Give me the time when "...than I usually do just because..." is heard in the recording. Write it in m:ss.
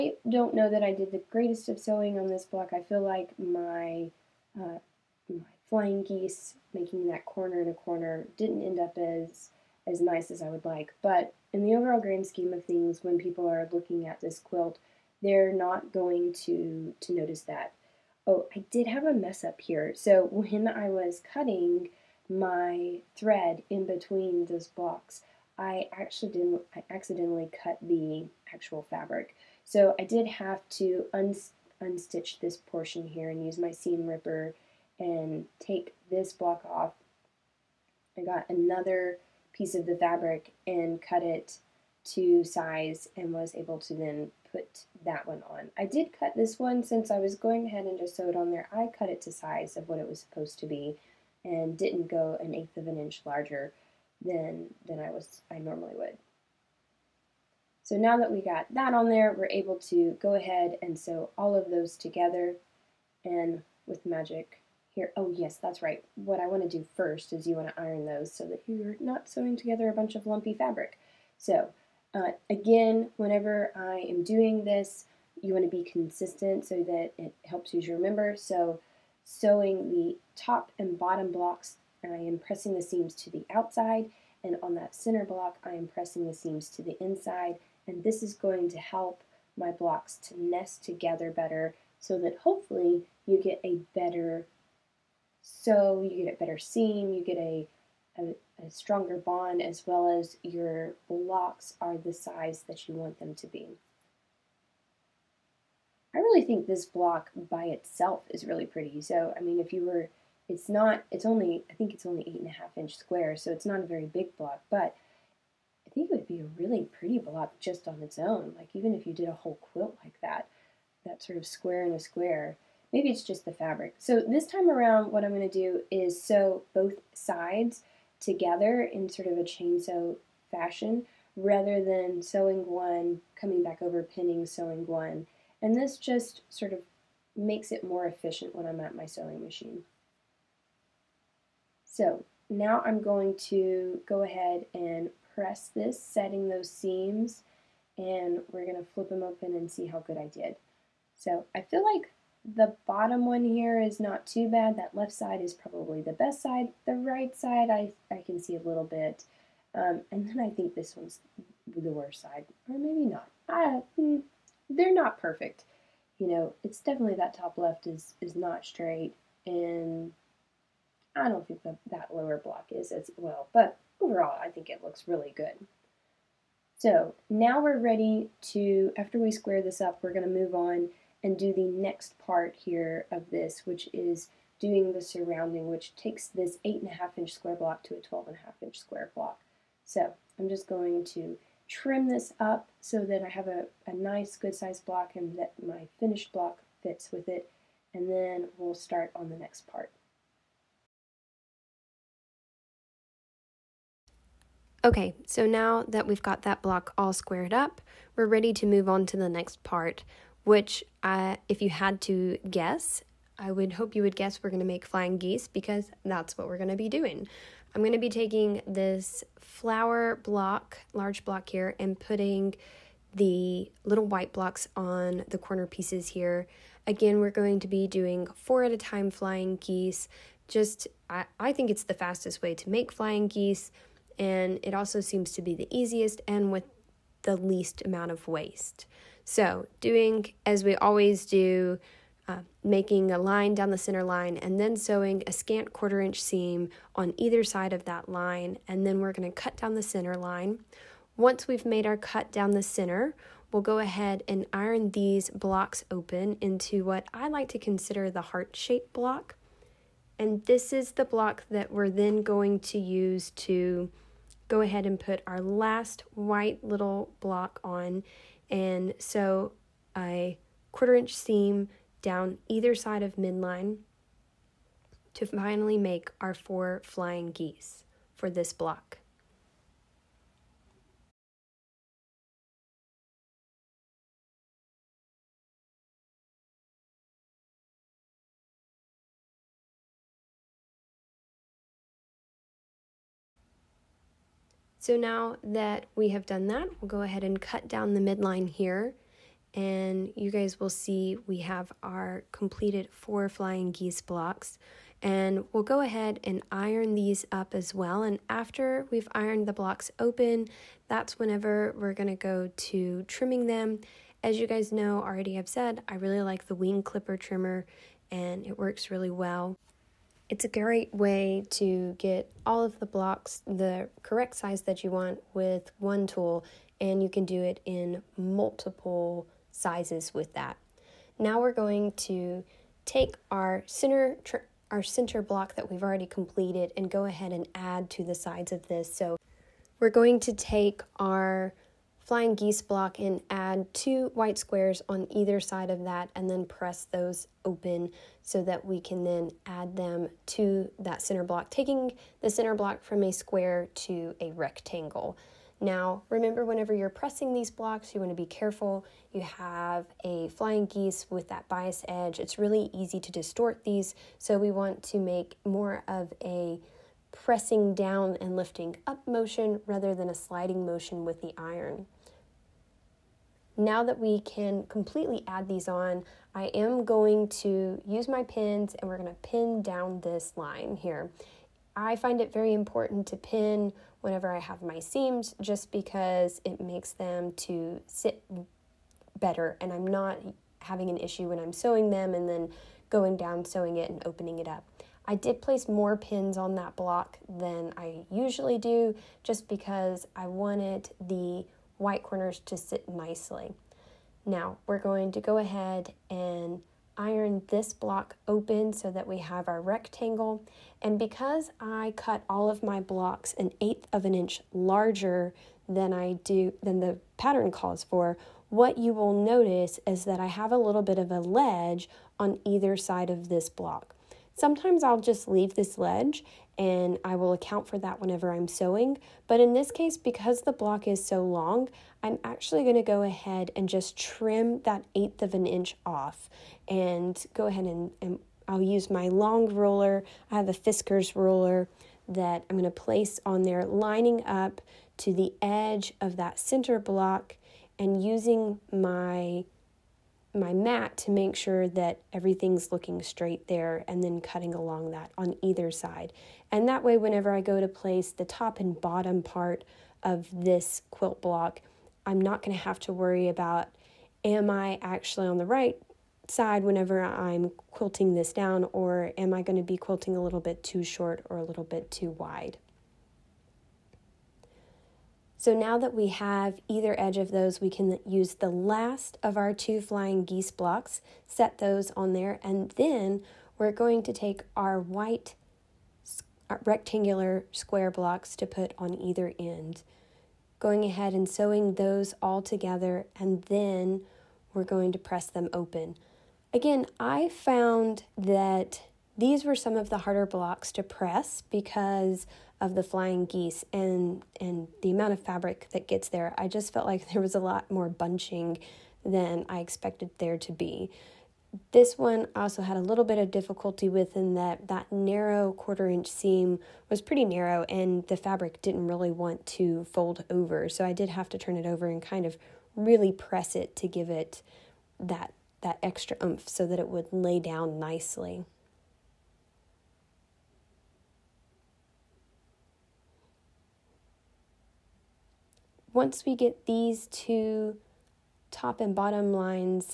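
6:37.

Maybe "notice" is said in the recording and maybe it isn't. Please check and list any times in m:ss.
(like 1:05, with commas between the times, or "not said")
0:17, 6:59.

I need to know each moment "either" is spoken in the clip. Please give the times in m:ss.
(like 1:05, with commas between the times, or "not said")
4:07, 4:32, 5:45, 7:02, 7:35, 7:56, 8:08.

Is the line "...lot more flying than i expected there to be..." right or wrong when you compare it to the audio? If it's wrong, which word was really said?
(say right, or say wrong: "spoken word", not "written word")
wrong: "bunching", not "flying".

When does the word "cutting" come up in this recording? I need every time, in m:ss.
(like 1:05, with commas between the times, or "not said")
0:21, 7:34.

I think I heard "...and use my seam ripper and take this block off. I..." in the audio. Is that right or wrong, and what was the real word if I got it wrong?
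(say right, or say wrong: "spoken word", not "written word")
right.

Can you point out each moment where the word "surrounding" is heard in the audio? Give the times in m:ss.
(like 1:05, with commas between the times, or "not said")
3:04.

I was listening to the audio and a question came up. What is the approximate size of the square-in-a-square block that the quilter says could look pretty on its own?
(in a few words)
8.5 inch square.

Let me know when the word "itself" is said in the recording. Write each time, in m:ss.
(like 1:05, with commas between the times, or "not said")
1:47.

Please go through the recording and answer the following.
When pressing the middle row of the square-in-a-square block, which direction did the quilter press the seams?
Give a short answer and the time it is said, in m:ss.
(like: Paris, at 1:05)
to the inside, at 1:26.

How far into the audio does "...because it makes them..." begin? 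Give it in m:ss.
6:25.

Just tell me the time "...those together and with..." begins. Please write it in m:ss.
1:01.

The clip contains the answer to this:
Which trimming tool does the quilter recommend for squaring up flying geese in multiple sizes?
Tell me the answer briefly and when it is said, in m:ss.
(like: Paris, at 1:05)
wing clipper trimmer, at 5:16.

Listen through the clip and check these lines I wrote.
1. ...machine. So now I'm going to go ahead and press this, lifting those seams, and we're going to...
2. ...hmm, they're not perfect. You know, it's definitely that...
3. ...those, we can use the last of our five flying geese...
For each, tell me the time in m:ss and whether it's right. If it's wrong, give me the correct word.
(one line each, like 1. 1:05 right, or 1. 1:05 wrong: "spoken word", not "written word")
1. 2:19 wrong: "setting", not "lifting"
2. 2:43 right
3. 7:57 wrong: "two", not "five".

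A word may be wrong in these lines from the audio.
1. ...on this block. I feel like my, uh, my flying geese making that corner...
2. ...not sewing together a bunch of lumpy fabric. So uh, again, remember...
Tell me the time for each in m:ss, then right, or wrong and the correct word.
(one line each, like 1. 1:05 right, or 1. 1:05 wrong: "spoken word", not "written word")
1. 0:02 right
2. 1:08 wrong: "whenever", not "remember".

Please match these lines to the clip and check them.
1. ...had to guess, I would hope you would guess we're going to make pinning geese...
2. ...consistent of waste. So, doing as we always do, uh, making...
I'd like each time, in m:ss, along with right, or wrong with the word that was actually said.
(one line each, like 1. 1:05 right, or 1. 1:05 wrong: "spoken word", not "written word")
1. 3:31 wrong: "flying", not "pinning"
2. 3:57 wrong: "amount", not "consistent".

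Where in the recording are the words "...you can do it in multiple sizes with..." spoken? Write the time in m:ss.
5:27.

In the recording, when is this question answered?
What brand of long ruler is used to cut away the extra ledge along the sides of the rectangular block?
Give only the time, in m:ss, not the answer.
7:20.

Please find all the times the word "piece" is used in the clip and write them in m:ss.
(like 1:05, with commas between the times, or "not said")
0:39, 3:45.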